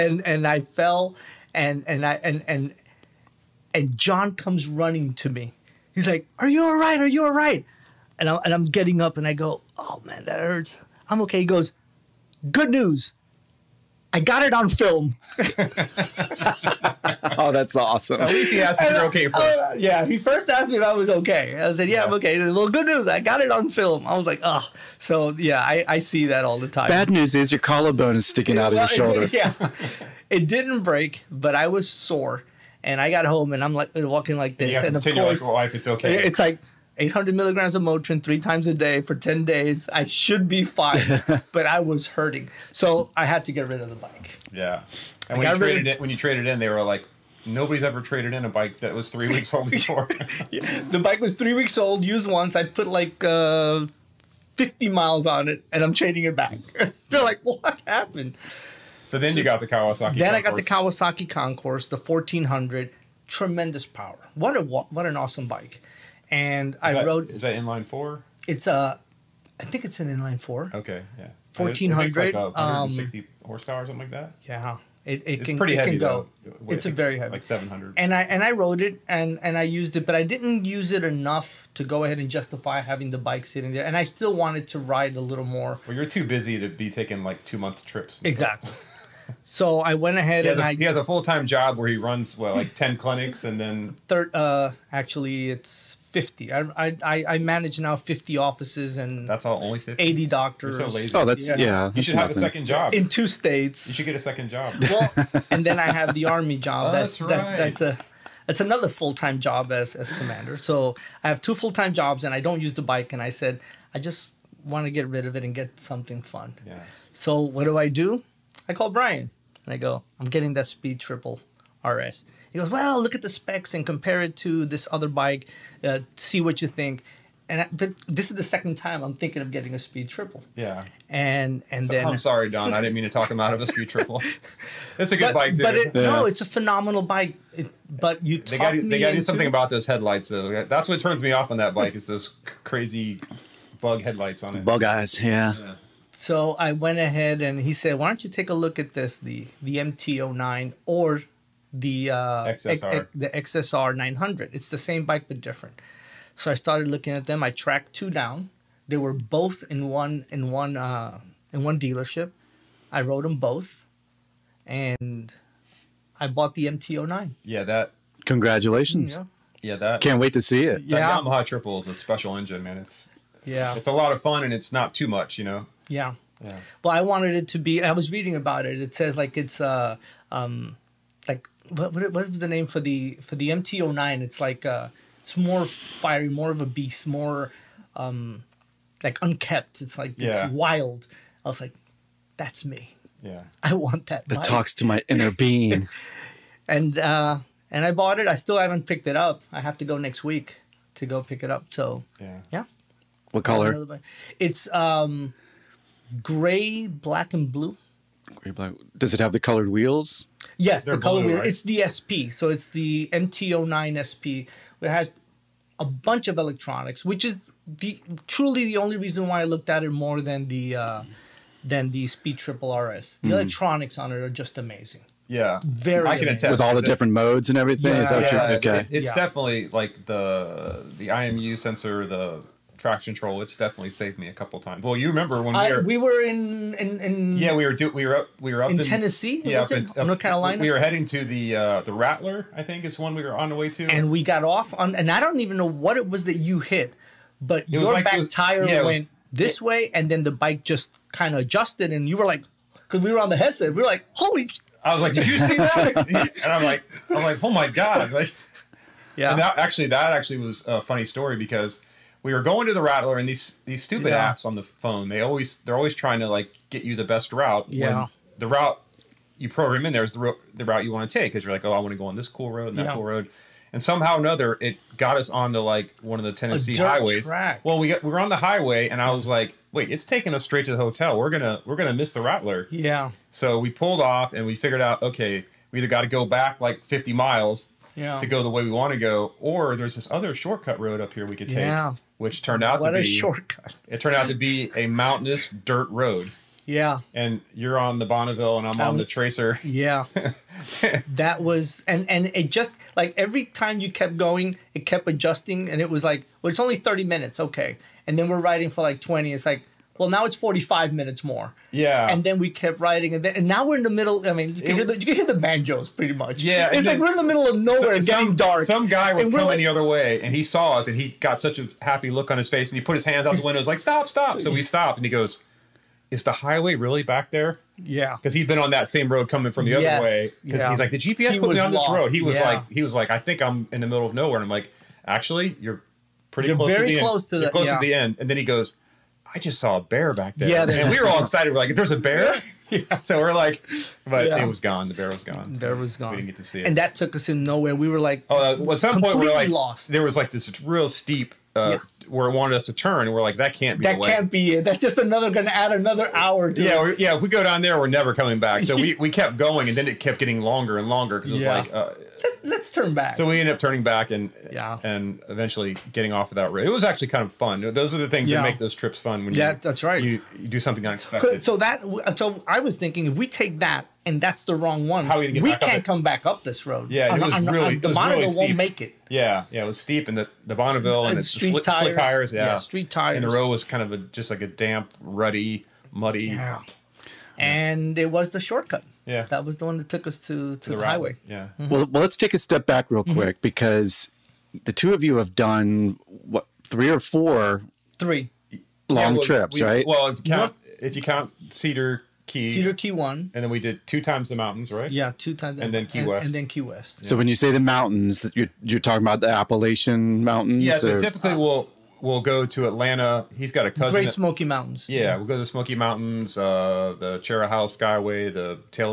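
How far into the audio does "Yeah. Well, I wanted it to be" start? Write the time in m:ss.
2:56.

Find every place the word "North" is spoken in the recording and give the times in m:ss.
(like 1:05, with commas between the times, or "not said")
4:00, 6:40.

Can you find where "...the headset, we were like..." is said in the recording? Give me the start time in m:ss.
4:13.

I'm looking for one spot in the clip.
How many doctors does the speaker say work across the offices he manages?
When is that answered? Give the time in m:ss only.
1:40.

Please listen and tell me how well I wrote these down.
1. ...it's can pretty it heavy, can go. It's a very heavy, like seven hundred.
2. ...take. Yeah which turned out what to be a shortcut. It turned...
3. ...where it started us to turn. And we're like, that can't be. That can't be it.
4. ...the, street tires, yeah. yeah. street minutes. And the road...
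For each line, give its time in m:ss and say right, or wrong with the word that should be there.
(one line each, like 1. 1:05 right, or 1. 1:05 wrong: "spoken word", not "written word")
1. 1:15 right
2. 4:51 right
3. 5:52 wrong: "wanted", not "started"
4. 6:21 wrong: "tires", not "minutes".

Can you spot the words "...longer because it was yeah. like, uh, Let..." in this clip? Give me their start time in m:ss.
6:00.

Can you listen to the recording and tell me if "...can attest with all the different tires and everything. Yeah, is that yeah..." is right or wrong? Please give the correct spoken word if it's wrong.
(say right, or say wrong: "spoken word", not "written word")
wrong: "modes", not "tires".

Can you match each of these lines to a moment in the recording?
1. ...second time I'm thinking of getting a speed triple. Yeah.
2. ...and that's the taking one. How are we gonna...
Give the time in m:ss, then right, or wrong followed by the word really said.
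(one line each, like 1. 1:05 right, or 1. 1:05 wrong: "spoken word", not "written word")
1. 2:08 right
2. 6:14 wrong: "wrong", not "taking".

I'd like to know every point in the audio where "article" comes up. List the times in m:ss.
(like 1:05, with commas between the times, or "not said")
not said.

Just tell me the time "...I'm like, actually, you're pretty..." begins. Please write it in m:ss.
5:34.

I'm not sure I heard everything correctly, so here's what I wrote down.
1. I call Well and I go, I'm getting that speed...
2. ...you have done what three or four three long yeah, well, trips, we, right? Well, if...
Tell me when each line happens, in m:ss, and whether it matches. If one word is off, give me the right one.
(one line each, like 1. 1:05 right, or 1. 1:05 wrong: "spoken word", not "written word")
1. 1:58 wrong: "Bryan", not "Well"
2. 6:35 right.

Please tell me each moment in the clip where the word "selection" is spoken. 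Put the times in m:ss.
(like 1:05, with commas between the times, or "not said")
not said.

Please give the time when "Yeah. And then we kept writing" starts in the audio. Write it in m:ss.
5:11.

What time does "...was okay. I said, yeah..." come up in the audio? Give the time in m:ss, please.
0:20.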